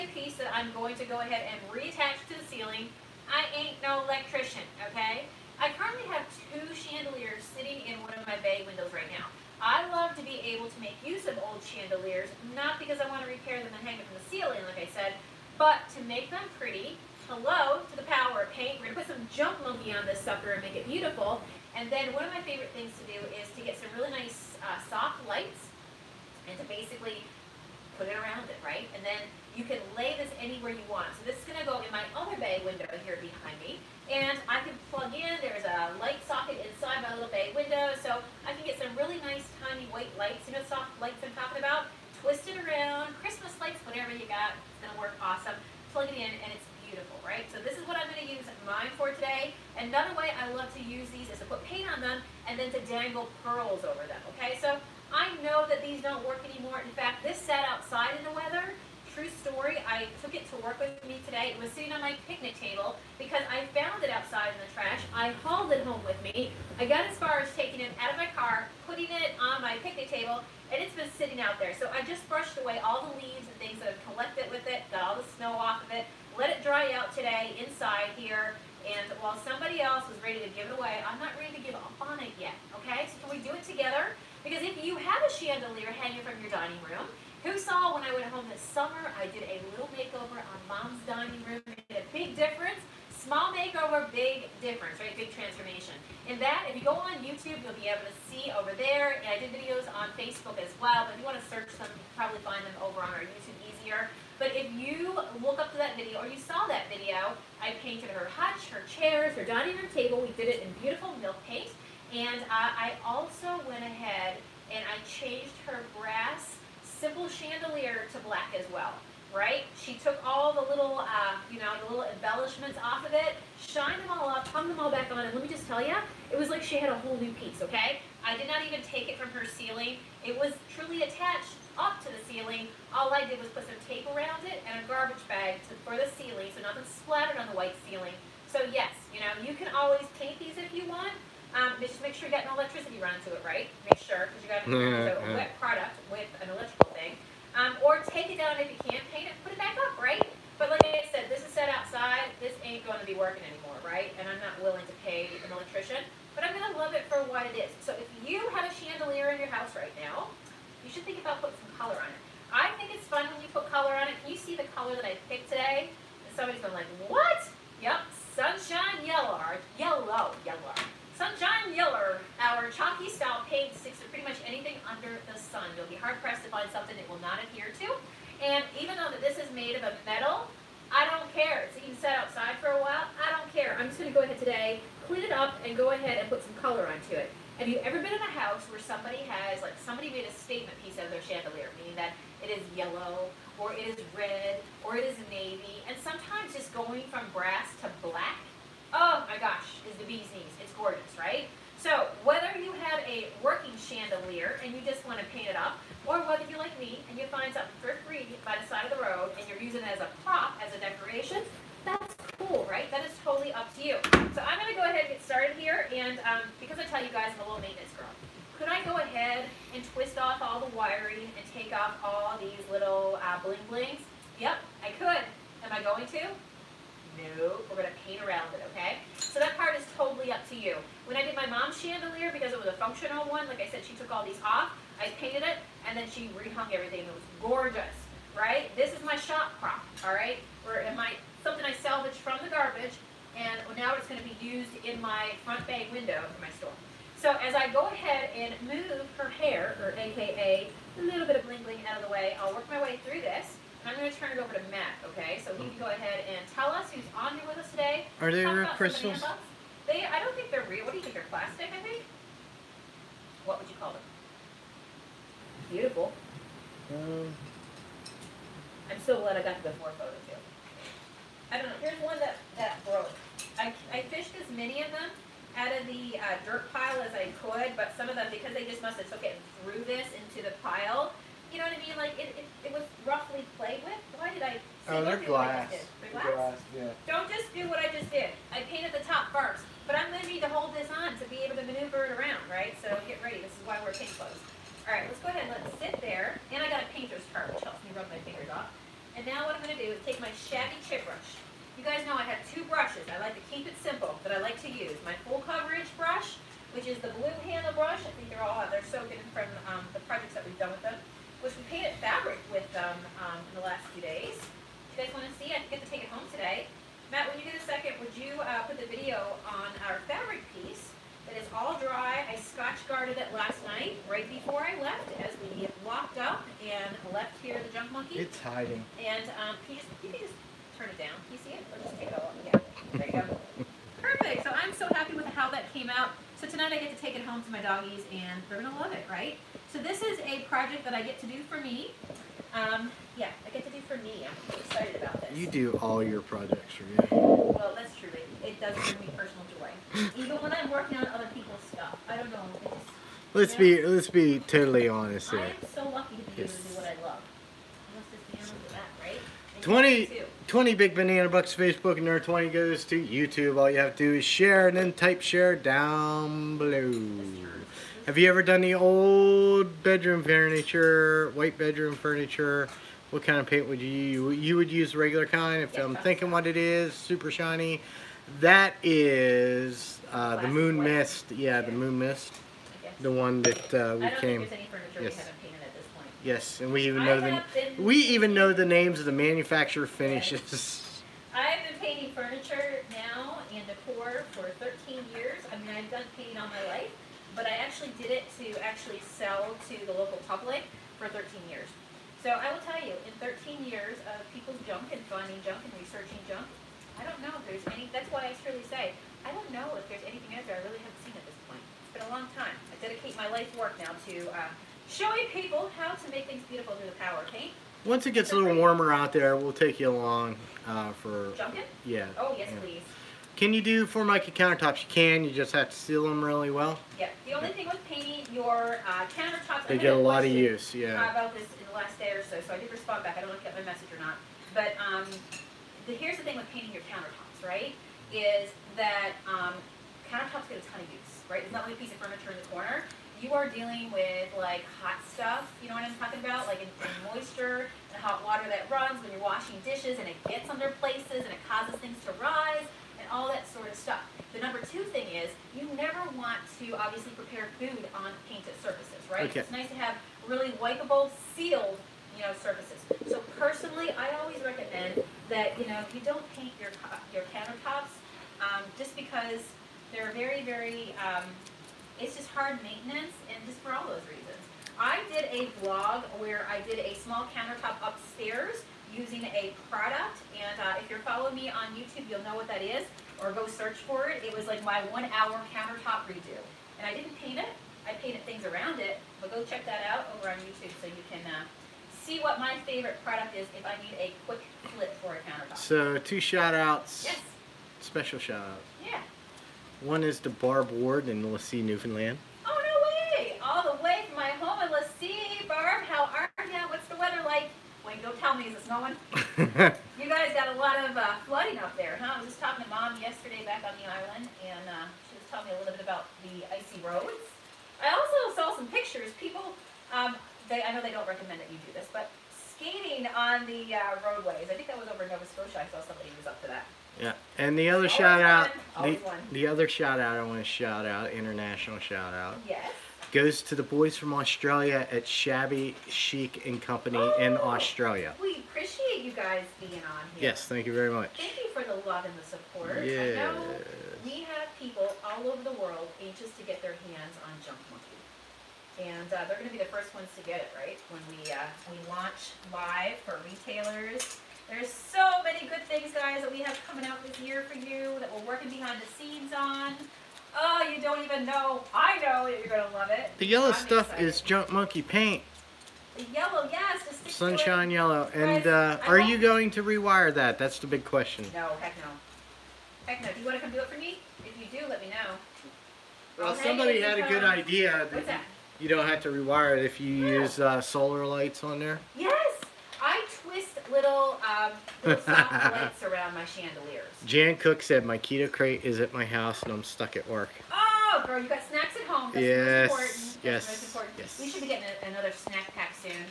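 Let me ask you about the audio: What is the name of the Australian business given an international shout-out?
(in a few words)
Shabby Chic and Company.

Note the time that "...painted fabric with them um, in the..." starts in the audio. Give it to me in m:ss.
5:11.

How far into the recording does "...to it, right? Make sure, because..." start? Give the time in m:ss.
2:23.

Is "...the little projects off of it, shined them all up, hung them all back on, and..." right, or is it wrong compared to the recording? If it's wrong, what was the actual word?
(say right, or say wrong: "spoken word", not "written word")
wrong: "embellishments", not "projects".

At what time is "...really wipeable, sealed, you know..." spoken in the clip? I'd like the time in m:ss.
7:40.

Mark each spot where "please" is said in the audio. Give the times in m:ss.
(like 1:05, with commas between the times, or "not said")
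7:02.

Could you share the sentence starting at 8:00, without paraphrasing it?
And uh, if you're following me on YouTube, you'll know what that is, or go search for it.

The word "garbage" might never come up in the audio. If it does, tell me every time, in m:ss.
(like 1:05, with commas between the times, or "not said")
2:14, 4:02.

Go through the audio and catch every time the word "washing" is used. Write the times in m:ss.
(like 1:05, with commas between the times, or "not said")
7:29.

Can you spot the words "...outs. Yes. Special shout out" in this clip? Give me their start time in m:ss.
8:16.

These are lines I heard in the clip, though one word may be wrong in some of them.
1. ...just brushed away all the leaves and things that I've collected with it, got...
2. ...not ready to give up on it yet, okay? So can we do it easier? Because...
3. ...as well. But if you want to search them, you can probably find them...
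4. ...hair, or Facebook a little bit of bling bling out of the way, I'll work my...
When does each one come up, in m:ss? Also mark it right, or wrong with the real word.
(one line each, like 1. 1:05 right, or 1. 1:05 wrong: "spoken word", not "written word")
1. 1:12 right
2. 1:21 wrong: "together", not "easier"
3. 1:40 right
4. 4:09 wrong: "AKA", not "Facebook".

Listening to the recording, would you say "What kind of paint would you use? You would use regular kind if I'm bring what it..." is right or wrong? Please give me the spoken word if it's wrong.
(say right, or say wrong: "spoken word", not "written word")
wrong: "thinking", not "bring".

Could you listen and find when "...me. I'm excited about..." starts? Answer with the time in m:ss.
5:44.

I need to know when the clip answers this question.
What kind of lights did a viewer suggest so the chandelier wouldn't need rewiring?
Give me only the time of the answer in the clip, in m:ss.
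9:40.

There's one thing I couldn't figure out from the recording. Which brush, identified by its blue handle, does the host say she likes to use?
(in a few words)
full coverage brush.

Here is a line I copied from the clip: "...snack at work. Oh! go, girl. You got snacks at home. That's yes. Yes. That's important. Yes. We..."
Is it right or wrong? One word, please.
wrong.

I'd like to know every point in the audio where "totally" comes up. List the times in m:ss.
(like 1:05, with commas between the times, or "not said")
3:33, 3:49, 5:54.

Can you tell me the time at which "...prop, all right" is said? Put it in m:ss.
3:59.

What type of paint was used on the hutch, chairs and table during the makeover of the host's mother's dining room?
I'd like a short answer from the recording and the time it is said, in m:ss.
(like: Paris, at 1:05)
milk paint, at 1:51.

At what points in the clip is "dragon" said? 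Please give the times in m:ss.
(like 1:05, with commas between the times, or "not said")
not said.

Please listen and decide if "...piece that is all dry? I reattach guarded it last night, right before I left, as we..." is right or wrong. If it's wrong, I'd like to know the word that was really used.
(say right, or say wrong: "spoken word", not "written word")
wrong: "scotch", not "reattach".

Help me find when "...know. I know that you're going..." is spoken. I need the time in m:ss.
9:21.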